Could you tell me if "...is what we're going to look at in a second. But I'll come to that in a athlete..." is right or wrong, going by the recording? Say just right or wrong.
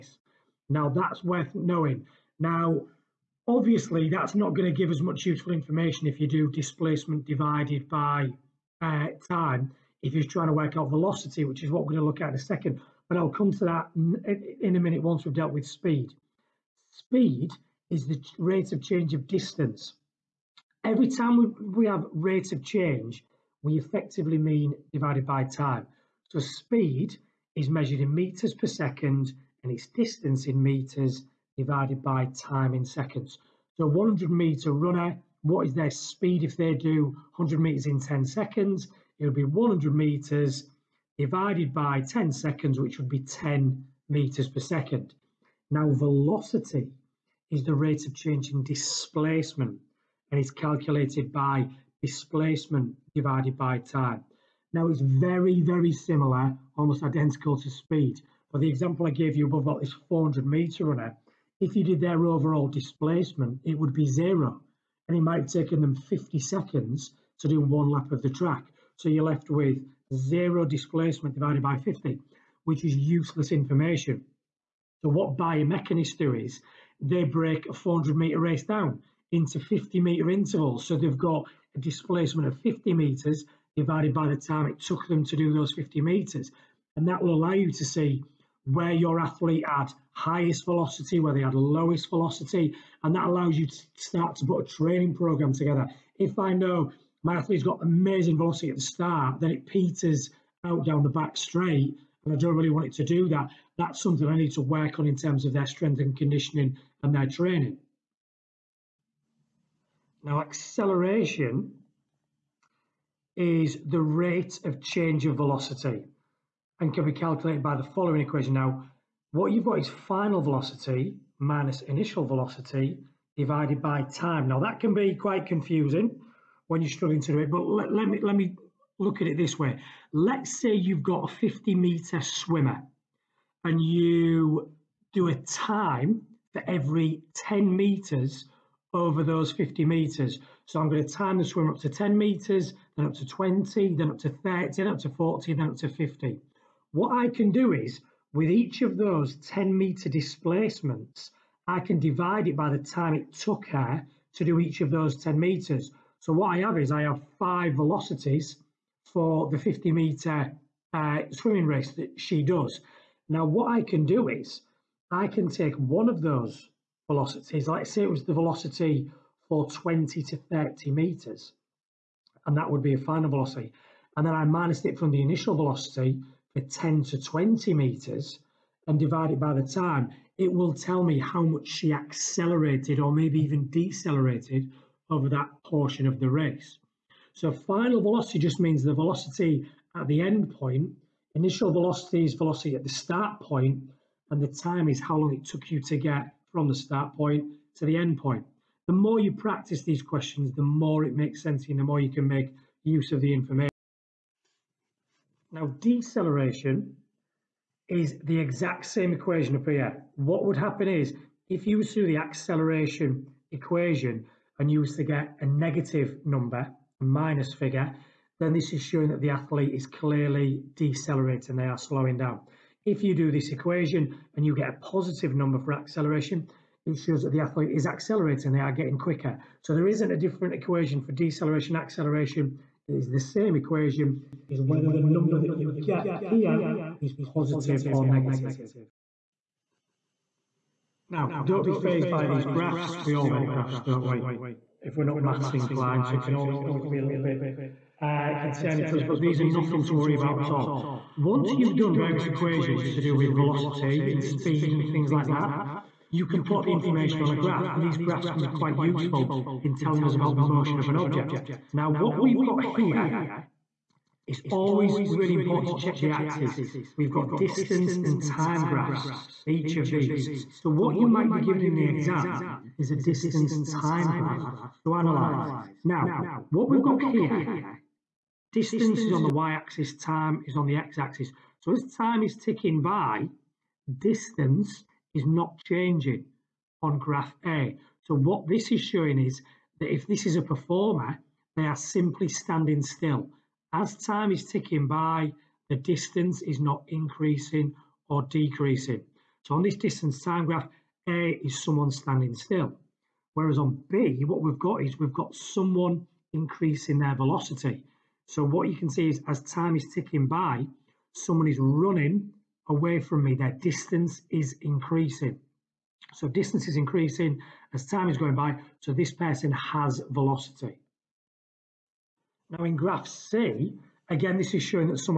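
wrong.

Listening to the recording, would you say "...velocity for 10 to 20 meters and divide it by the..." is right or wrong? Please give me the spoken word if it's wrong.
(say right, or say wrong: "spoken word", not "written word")
right.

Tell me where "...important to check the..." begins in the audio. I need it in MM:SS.
04:25.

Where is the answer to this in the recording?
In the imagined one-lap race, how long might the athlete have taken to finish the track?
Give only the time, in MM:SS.
01:05.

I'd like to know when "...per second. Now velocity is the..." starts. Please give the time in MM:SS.
00:44.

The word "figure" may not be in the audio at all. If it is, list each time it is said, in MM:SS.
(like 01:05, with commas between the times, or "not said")
03:37.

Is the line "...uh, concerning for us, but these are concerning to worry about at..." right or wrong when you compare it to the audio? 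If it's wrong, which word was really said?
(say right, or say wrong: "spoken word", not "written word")
wrong: "nothing", not "concerning".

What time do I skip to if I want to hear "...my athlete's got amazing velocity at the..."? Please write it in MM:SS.
01:37.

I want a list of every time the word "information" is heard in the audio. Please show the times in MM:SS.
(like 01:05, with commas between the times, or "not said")
00:05, 01:13, 03:23, 04:16.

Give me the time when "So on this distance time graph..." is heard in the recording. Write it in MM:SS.
04:59.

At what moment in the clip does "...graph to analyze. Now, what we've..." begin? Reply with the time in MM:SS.
04:34.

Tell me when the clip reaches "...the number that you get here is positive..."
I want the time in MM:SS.
03:54.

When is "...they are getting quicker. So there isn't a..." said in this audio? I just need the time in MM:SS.
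03:48.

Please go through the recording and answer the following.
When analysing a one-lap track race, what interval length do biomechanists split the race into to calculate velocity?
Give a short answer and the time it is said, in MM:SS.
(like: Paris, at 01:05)
50 metre intervals, at 01:19.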